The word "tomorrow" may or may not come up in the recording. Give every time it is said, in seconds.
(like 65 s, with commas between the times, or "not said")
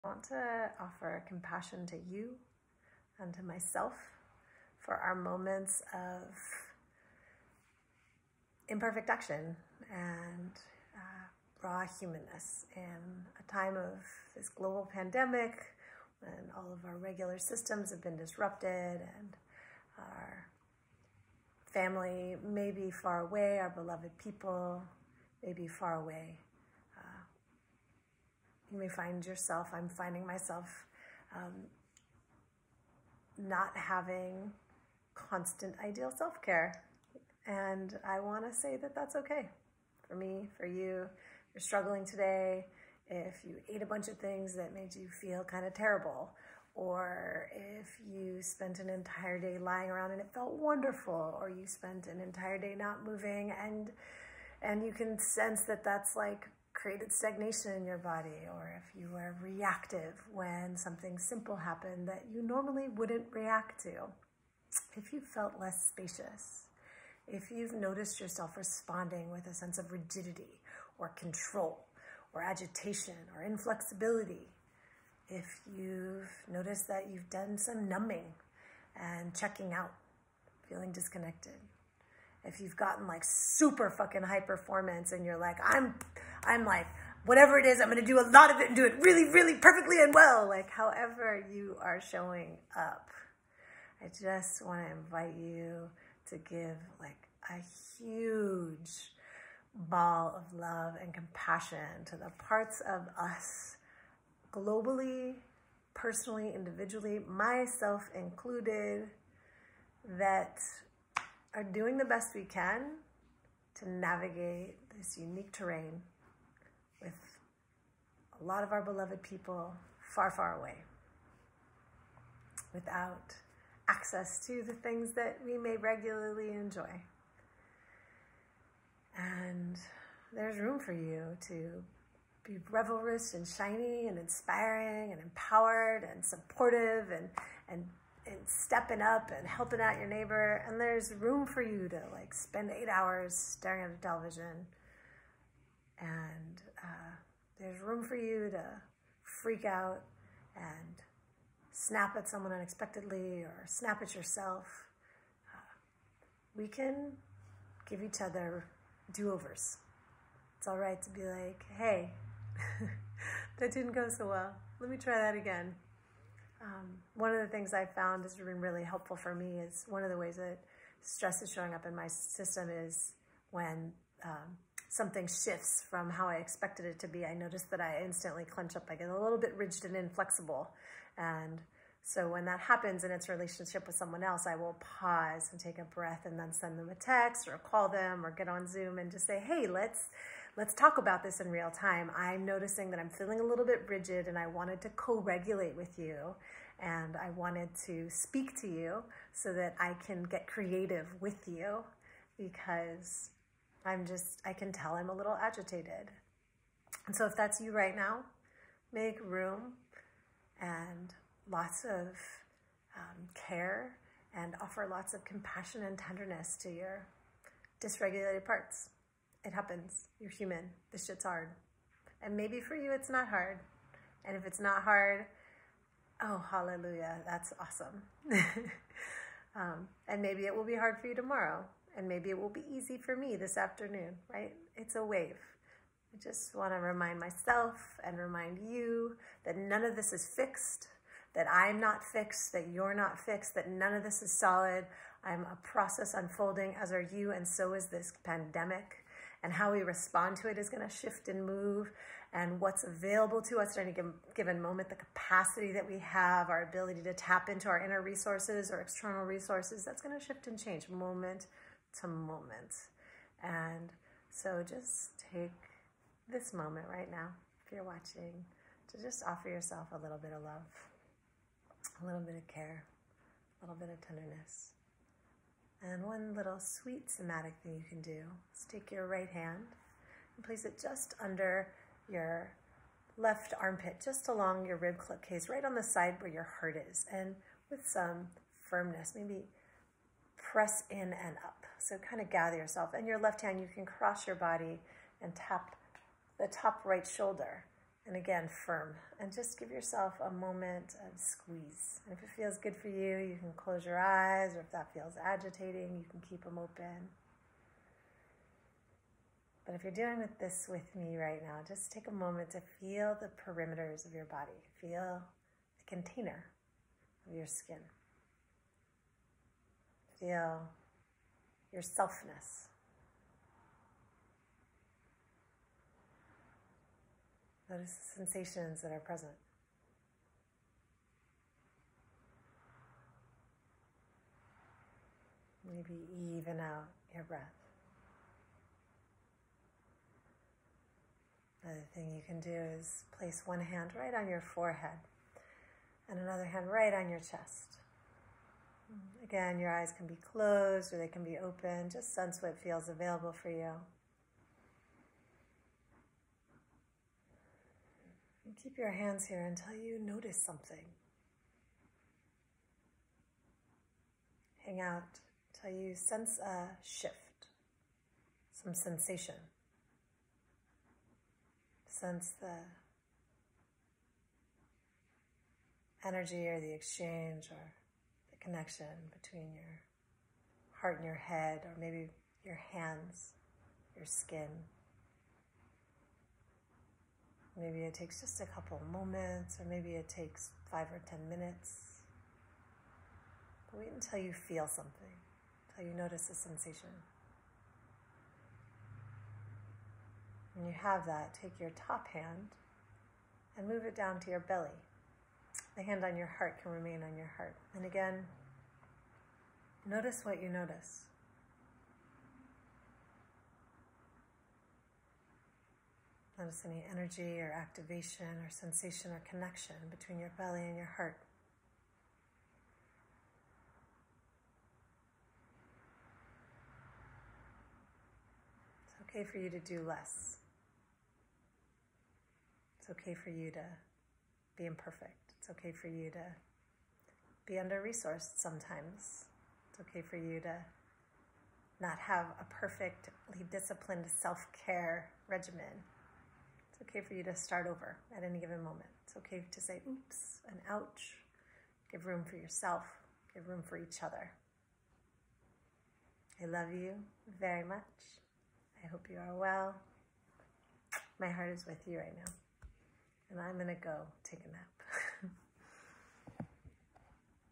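231 s.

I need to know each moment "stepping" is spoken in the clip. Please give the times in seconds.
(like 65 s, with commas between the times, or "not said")
138 s.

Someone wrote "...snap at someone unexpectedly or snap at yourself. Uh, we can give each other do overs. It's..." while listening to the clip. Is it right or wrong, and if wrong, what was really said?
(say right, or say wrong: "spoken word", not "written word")
right.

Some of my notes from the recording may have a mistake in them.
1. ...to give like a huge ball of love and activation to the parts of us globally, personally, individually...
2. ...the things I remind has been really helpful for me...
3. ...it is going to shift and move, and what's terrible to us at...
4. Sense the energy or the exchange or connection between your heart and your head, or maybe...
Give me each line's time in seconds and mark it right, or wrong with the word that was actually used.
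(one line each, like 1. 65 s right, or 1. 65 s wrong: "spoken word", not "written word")
1. 96 s wrong: "compassion", not "activation"
2. 167 s wrong: "found", not "remind"
3. 250 s wrong: "available", not "terrible"
4. 371 s right.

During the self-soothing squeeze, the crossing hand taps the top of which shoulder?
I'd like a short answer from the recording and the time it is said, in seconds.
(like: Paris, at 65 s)
Right shoulder, at 296 s.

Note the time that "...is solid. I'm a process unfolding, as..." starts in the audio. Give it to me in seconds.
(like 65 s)
244 s.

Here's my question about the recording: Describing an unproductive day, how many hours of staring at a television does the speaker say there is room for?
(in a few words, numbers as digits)
8.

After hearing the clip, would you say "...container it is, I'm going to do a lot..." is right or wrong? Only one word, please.
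wrong.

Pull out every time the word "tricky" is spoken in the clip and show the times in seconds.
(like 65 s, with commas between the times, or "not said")
not said.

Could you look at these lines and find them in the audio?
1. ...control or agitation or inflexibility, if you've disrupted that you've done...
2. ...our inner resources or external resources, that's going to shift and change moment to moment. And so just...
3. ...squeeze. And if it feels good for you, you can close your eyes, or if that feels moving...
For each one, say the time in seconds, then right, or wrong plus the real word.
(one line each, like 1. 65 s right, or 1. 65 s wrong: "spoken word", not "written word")
1. 71 s wrong: "noticed", not "disrupted"
2. 257 s right
3. 301 s wrong: "agitating", not "moving".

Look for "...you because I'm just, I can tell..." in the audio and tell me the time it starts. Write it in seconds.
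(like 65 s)
201 s.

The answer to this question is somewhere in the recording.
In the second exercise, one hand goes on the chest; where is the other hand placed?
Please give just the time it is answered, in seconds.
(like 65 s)
344 s.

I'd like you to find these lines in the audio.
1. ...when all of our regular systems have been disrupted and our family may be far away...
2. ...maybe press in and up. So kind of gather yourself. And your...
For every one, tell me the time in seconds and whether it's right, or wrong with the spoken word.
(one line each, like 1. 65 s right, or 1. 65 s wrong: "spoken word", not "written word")
1. 16 s right
2. 289 s right.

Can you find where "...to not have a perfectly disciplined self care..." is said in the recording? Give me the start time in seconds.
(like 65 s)
440 s.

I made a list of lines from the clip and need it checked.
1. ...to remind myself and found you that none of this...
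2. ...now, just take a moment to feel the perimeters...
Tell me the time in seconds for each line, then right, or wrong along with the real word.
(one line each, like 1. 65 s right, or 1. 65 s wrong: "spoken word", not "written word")
1. 236 s wrong: "remind", not "found"
2. 311 s right.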